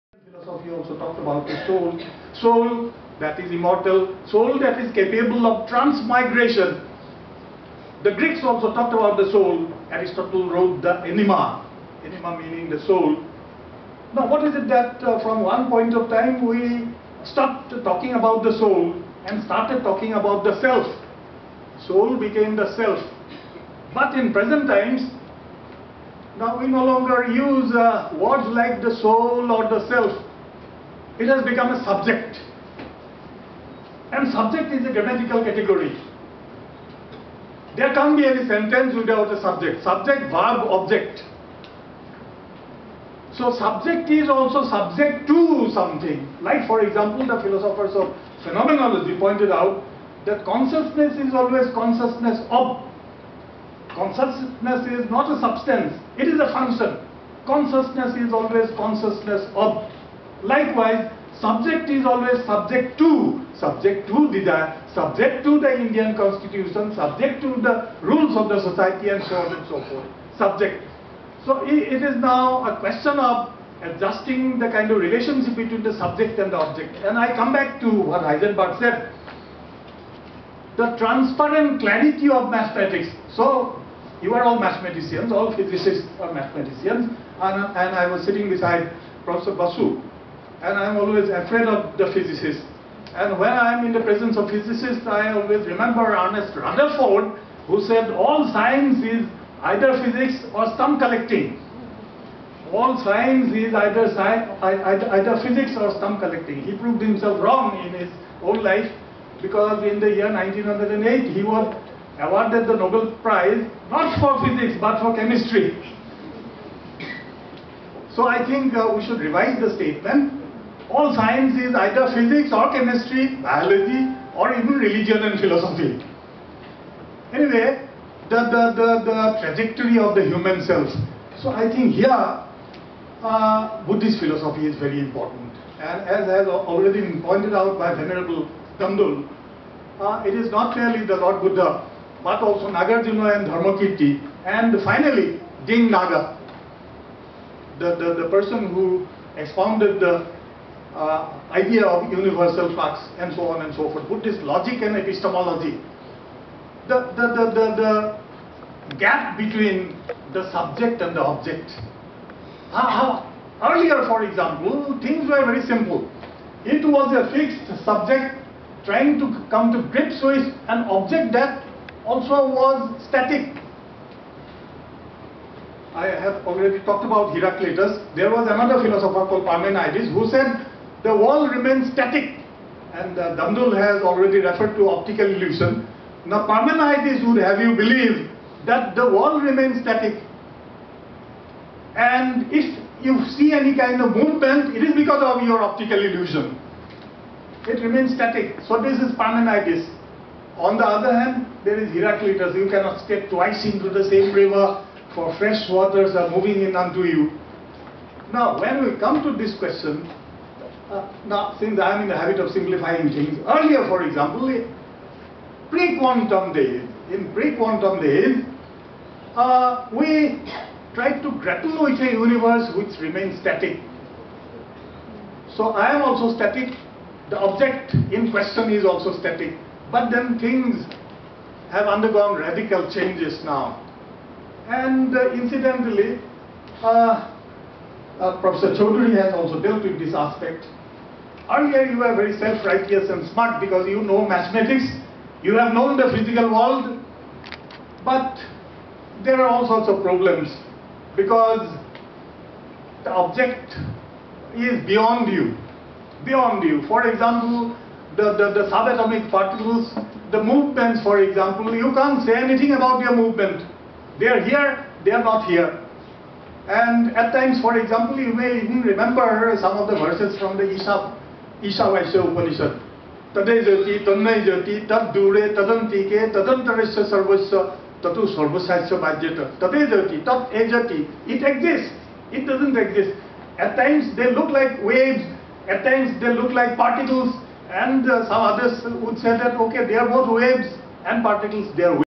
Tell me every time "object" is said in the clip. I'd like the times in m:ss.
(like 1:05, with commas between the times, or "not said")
0:40, 1:16, 2:41, 2:50, 3:47, 4:13.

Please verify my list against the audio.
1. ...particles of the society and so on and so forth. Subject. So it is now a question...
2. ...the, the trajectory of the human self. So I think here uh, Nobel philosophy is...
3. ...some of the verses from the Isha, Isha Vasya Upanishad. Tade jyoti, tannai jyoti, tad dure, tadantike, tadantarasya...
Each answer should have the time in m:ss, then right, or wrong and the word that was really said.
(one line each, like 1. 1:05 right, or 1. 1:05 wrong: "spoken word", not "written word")
1. 1:08 wrong: "rules", not "particles"
2. 2:08 wrong: "Buddhist", not "Nobel"
3. 4:29 right.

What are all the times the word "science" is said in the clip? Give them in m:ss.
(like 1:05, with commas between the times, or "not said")
1:38, 1:43, 2:01.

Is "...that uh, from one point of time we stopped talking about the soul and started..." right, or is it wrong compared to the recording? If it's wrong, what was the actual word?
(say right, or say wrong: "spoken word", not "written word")
right.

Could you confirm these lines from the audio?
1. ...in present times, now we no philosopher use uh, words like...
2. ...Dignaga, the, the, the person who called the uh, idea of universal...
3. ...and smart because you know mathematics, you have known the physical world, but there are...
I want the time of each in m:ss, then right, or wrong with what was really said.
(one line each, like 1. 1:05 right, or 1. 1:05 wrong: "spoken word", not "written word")
1. 0:24 wrong: "longer", not "philosopher"
2. 2:25 wrong: "expounded", not "called"
3. 4:03 right.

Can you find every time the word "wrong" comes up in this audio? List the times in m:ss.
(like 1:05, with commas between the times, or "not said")
1:47.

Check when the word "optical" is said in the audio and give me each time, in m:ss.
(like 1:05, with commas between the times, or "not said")
3:04, 3:15.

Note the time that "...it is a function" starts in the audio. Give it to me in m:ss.
0:56.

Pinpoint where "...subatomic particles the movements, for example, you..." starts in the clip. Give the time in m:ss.
4:18.